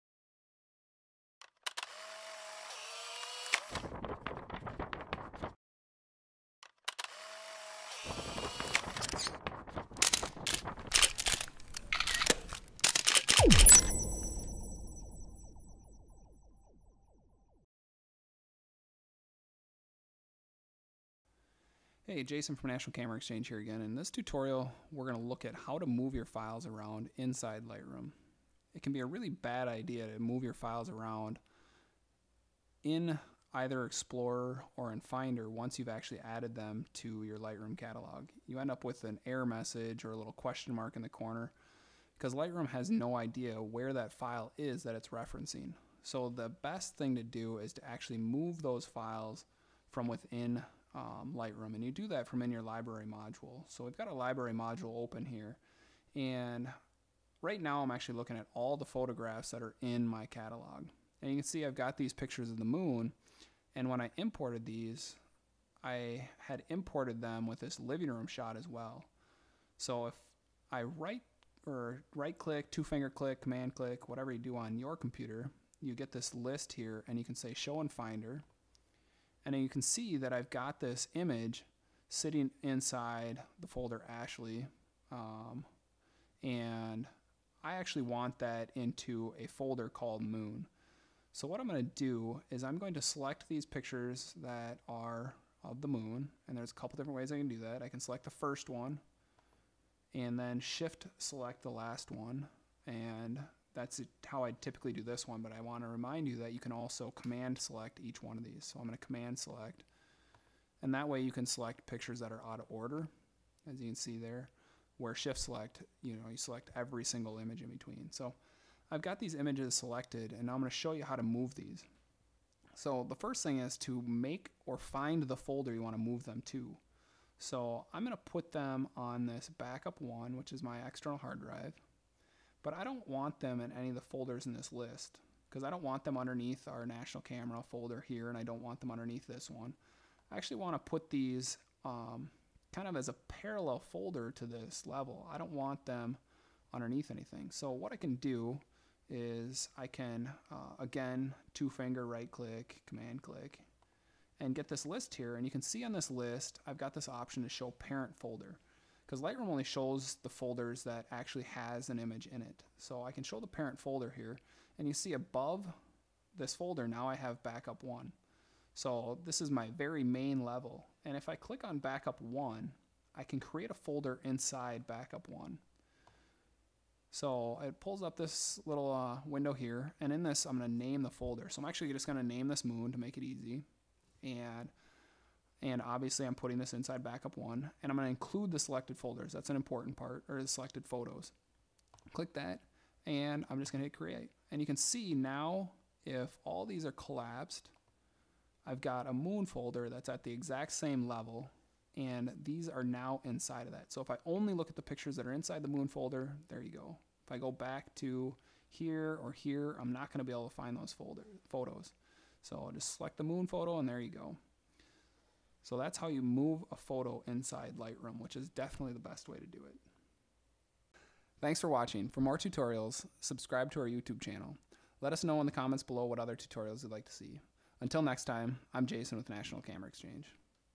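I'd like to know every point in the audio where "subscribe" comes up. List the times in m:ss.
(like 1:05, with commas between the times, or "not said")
3:43.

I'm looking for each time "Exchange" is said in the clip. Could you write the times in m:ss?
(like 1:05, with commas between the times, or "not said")
0:23, 3:49.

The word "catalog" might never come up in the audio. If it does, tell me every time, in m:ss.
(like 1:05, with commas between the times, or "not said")
0:37, 1:00.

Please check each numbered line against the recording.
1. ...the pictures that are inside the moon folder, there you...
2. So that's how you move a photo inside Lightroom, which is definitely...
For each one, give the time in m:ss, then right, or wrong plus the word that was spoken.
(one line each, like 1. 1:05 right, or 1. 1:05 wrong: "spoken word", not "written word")
1. 3:24 right
2. 3:35 right.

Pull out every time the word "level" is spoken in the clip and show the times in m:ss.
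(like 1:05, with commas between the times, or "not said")
2:24, 2:50, 3:21.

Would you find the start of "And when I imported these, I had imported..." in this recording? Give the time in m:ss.
1:03.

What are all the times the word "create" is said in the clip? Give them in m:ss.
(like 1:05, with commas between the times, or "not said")
2:53, 3:13.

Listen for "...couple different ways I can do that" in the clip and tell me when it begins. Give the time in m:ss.
1:36.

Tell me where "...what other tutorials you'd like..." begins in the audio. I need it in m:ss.
3:46.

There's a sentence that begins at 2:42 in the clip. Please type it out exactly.
So I can show the parent folder here and you see above this folder now I have backup one.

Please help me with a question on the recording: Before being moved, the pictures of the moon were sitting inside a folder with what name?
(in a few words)
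Ashley.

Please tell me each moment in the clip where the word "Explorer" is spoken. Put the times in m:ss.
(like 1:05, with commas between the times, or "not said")
0:33.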